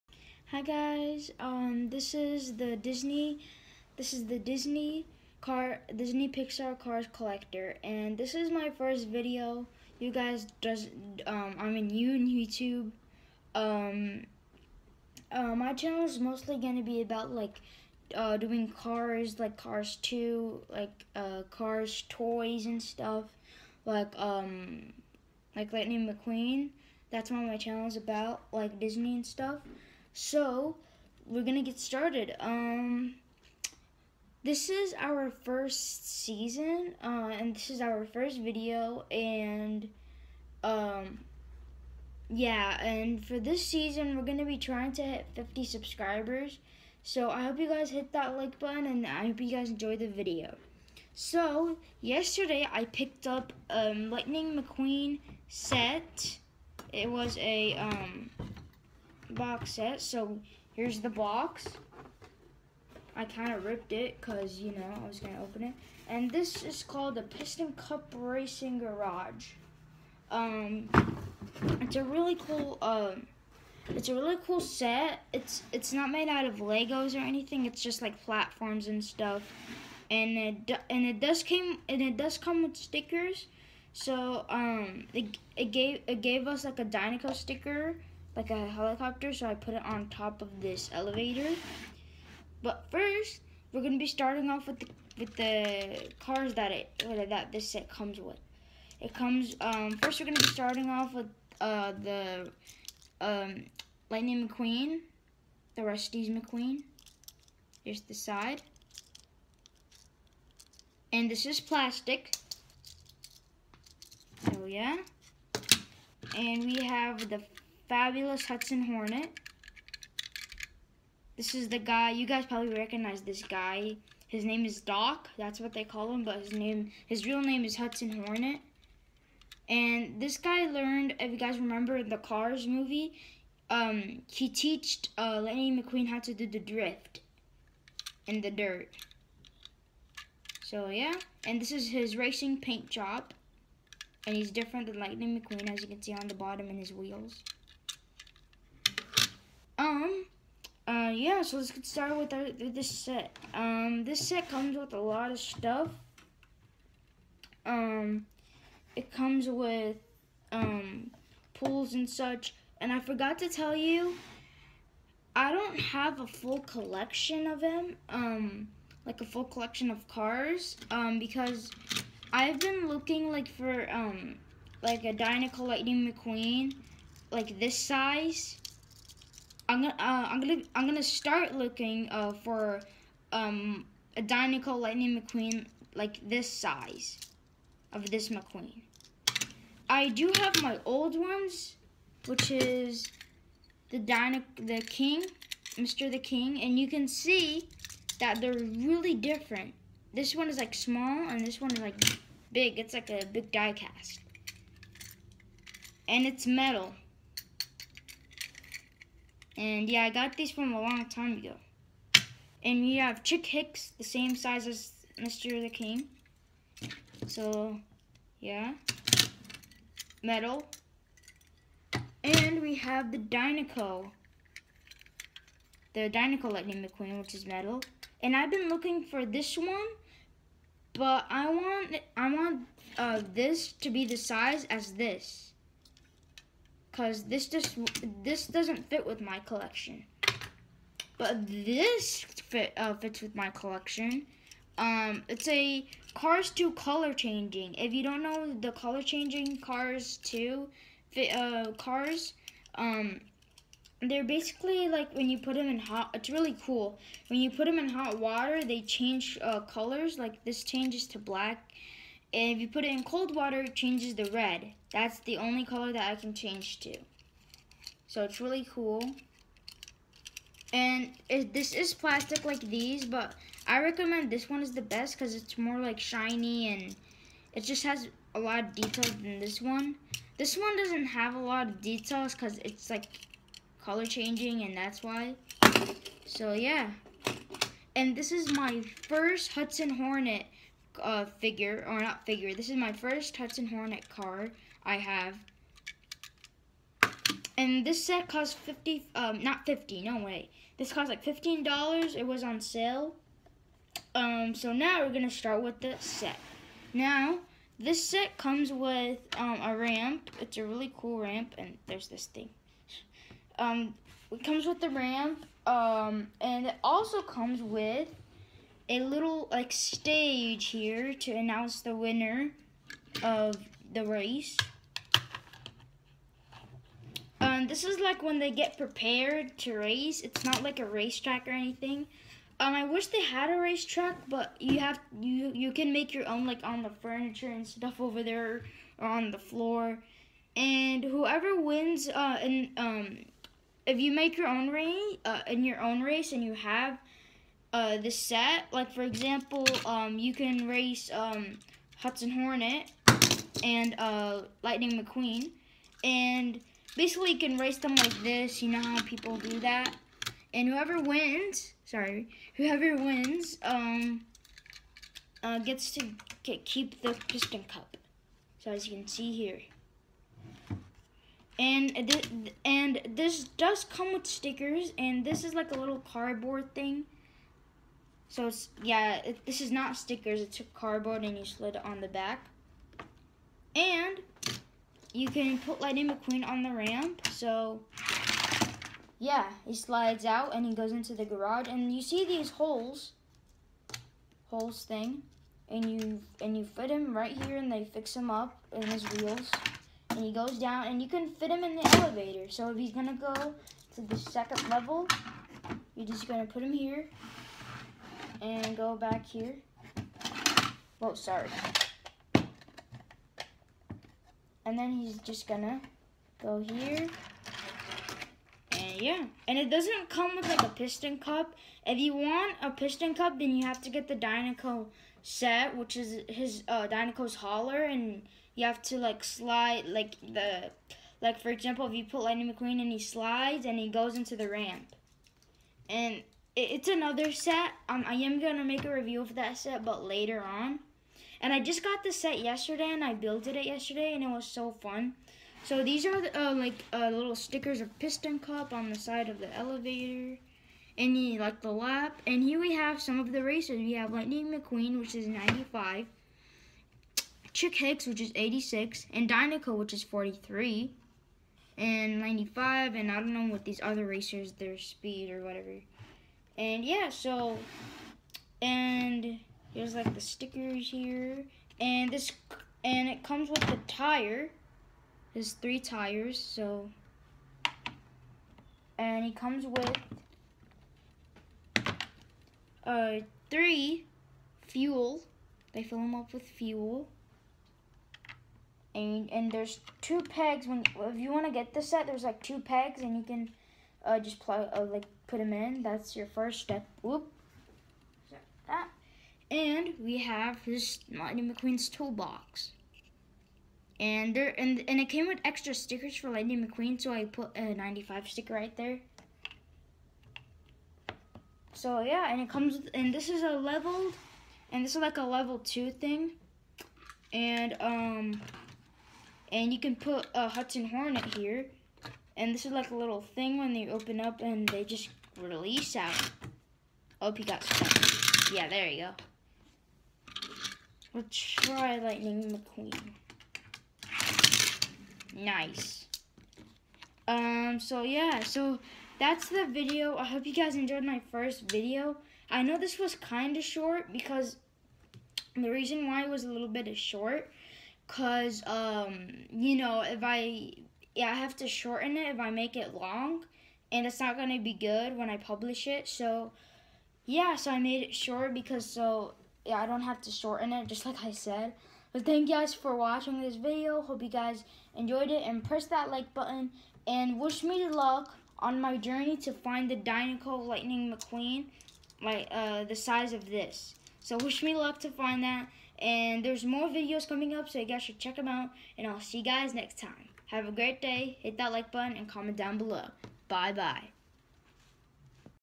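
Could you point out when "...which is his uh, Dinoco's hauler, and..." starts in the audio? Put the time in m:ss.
7:05.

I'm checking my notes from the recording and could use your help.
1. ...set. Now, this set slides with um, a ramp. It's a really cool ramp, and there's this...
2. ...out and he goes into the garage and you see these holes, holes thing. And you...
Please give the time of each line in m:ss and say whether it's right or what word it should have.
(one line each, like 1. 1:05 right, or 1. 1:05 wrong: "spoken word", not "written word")
1. 5:05 wrong: "comes", not "slides"
2. 6:30 right.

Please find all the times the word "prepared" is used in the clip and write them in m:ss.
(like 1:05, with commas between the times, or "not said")
5:28.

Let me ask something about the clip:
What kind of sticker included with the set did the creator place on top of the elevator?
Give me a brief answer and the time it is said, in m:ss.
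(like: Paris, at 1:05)
Dinoco sticker, at 1:26.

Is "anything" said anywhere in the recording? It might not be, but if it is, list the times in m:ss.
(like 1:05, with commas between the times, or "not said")
1:17, 5:31.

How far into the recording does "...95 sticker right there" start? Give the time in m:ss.
8:27.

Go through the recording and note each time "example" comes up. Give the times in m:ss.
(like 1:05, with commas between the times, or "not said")
5:49, 7:11.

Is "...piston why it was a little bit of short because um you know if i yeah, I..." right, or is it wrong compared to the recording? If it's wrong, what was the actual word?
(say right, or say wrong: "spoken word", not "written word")
wrong: "reason", not "piston".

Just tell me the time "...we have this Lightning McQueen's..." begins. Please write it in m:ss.
8:19.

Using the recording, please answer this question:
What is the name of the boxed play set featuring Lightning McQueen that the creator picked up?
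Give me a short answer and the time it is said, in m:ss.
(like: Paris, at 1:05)
Piston Cup Racing Garage, at 1:07.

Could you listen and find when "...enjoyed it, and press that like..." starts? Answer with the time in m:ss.
9:24.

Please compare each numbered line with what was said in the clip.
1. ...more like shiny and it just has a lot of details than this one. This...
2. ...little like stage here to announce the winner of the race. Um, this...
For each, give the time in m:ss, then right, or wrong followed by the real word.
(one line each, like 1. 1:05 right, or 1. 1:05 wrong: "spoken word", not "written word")
1. 4:35 right
2. 5:18 right.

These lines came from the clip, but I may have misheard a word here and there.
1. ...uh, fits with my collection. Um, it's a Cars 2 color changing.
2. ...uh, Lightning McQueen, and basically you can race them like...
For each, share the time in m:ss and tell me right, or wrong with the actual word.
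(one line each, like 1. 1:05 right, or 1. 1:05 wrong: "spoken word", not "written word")
1. 4:02 right
2. 5:53 right.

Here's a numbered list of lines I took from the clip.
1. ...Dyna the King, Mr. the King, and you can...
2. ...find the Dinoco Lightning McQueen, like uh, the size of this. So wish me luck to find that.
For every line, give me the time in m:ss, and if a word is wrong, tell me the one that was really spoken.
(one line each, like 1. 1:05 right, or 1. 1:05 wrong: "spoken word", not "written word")
1. 3:13 right
2. 9:29 right.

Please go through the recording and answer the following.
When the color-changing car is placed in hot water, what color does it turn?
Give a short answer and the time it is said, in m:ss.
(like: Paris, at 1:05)
black, at 4:21.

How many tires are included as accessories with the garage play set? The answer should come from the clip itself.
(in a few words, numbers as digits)
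3.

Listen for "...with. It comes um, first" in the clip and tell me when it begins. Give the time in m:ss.
1:38.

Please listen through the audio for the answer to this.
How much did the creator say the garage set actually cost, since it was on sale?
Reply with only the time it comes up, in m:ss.
5:01.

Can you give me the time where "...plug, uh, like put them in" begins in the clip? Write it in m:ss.
8:14.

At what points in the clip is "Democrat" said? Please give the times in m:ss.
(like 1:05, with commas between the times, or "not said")
not said.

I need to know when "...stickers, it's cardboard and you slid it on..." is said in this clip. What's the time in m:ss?
6:19.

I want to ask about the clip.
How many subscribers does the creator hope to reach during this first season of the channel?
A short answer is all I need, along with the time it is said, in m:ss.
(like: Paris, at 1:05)
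50, at 0:45.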